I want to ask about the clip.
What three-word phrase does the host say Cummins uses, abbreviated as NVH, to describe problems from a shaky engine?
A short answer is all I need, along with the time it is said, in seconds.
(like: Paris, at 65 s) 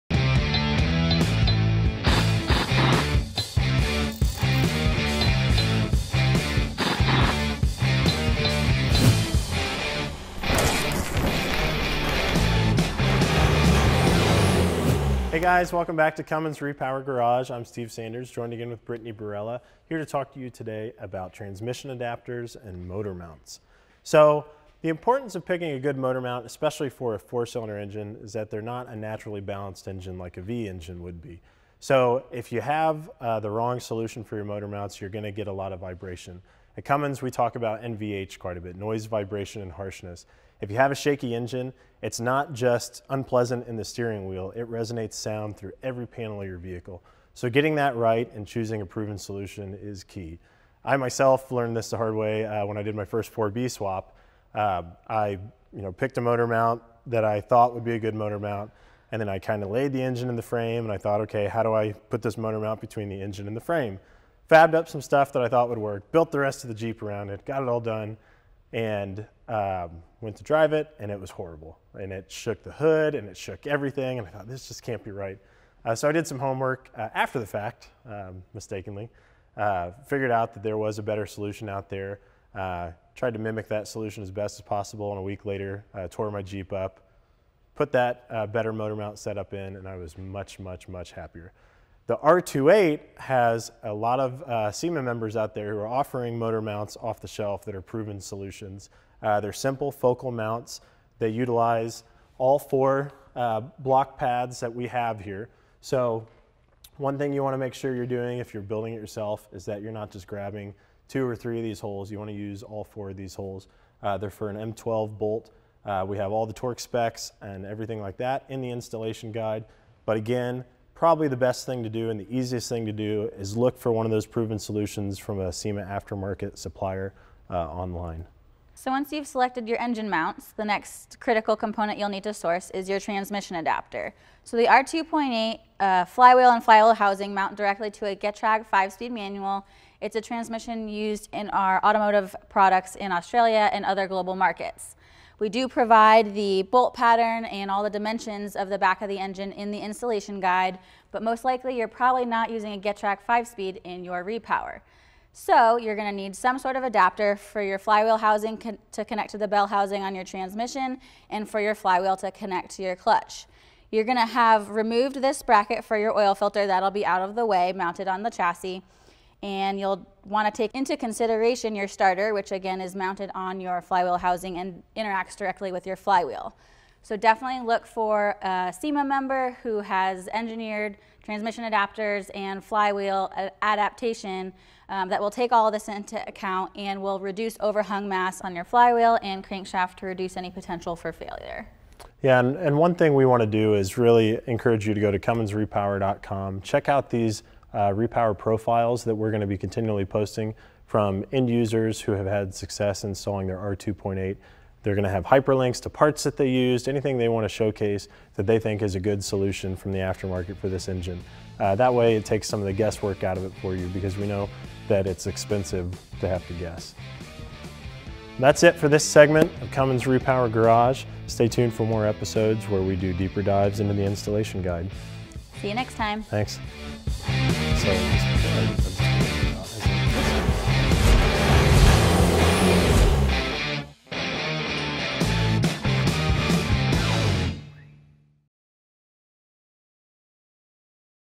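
noise, vibration, and harshness, at 38 s.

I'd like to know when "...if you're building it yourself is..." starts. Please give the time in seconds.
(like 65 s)
108 s.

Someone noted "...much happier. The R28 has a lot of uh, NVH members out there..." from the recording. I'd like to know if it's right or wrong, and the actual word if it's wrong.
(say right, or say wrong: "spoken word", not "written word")
wrong: "SEMA", not "NVH".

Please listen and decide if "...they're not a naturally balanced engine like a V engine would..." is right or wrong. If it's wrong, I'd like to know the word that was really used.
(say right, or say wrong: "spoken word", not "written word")
right.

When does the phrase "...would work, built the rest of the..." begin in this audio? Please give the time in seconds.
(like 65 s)
65 s.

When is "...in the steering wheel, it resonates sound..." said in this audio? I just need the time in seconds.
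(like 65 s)
43 s.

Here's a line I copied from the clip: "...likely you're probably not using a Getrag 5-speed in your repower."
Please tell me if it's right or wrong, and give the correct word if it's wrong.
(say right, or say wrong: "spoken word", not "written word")
right.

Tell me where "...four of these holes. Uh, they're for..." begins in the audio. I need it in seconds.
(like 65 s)
112 s.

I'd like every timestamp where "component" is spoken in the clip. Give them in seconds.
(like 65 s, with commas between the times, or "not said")
131 s.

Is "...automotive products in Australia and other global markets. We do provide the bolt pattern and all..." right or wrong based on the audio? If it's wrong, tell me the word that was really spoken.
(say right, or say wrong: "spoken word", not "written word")
right.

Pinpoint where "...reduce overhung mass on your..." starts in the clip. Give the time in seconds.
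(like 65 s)
187 s.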